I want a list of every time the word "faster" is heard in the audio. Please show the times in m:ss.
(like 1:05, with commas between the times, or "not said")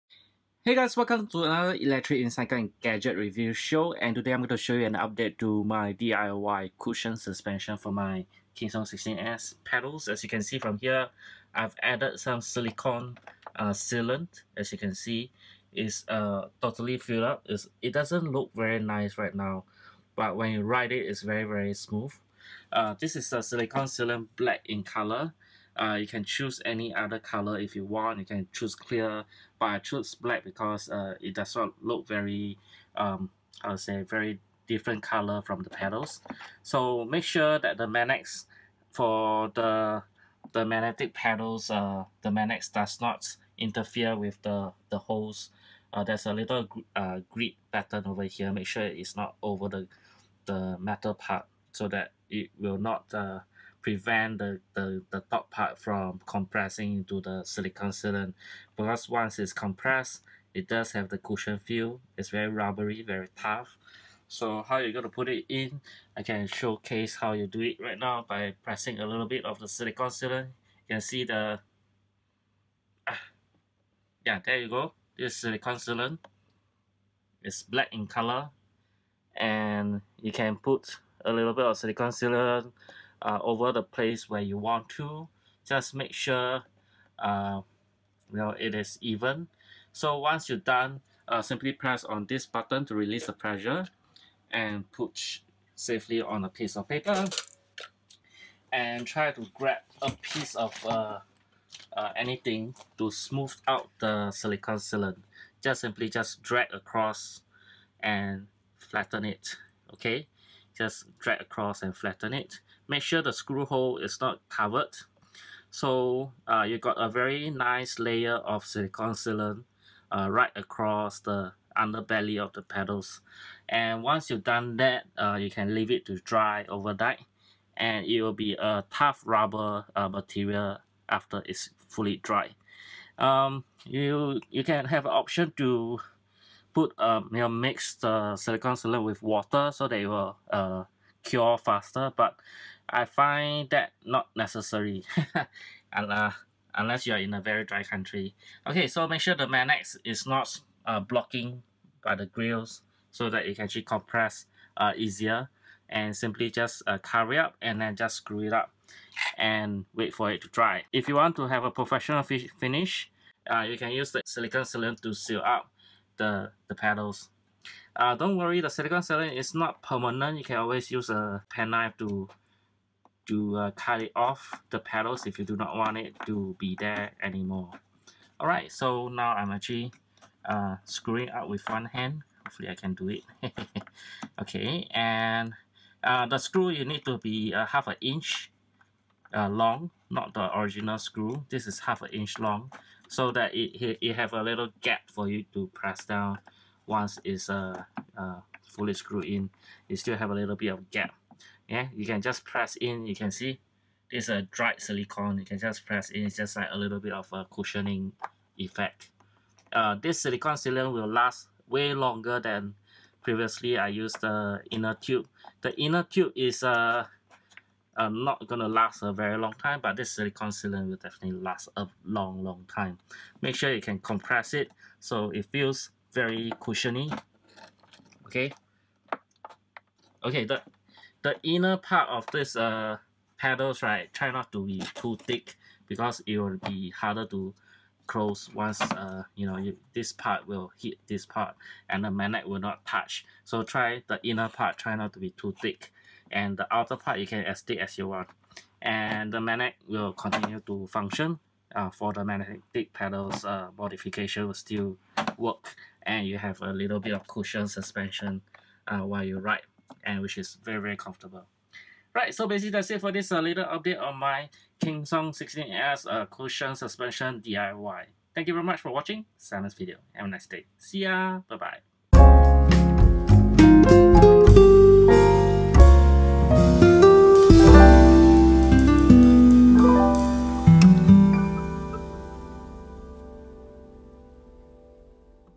2:21.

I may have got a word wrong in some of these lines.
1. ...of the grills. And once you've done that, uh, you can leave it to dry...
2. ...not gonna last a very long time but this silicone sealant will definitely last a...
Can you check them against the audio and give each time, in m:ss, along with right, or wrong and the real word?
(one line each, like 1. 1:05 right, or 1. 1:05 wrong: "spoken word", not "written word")
1. 2:02 wrong: "pedals", not "grills"
2. 3:38 right.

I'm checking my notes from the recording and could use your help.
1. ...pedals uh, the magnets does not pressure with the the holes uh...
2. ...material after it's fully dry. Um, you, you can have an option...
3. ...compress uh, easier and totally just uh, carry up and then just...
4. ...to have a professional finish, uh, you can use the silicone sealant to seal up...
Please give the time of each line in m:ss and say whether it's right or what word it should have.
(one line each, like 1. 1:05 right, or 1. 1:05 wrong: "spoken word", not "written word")
1. 0:41 wrong: "interfere", not "pressure"
2. 2:10 right
3. 2:33 wrong: "simply", not "totally"
4. 2:41 right.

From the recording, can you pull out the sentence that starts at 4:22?
Right, so basically that's it for this uh, little update on my KingSong 16S uh, cushion suspension DIY.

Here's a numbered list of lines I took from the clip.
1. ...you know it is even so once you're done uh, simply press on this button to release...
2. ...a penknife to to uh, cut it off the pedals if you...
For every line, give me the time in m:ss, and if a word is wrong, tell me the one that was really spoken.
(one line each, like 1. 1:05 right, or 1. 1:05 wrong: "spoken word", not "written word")
1. 1:28 right
2. 2:51 right.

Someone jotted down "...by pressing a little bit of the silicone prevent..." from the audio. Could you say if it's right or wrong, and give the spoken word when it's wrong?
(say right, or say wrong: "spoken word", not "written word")
wrong: "sealant", not "prevent".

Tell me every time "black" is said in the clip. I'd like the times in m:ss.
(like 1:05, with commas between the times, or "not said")
0:24, 0:30, 1:17.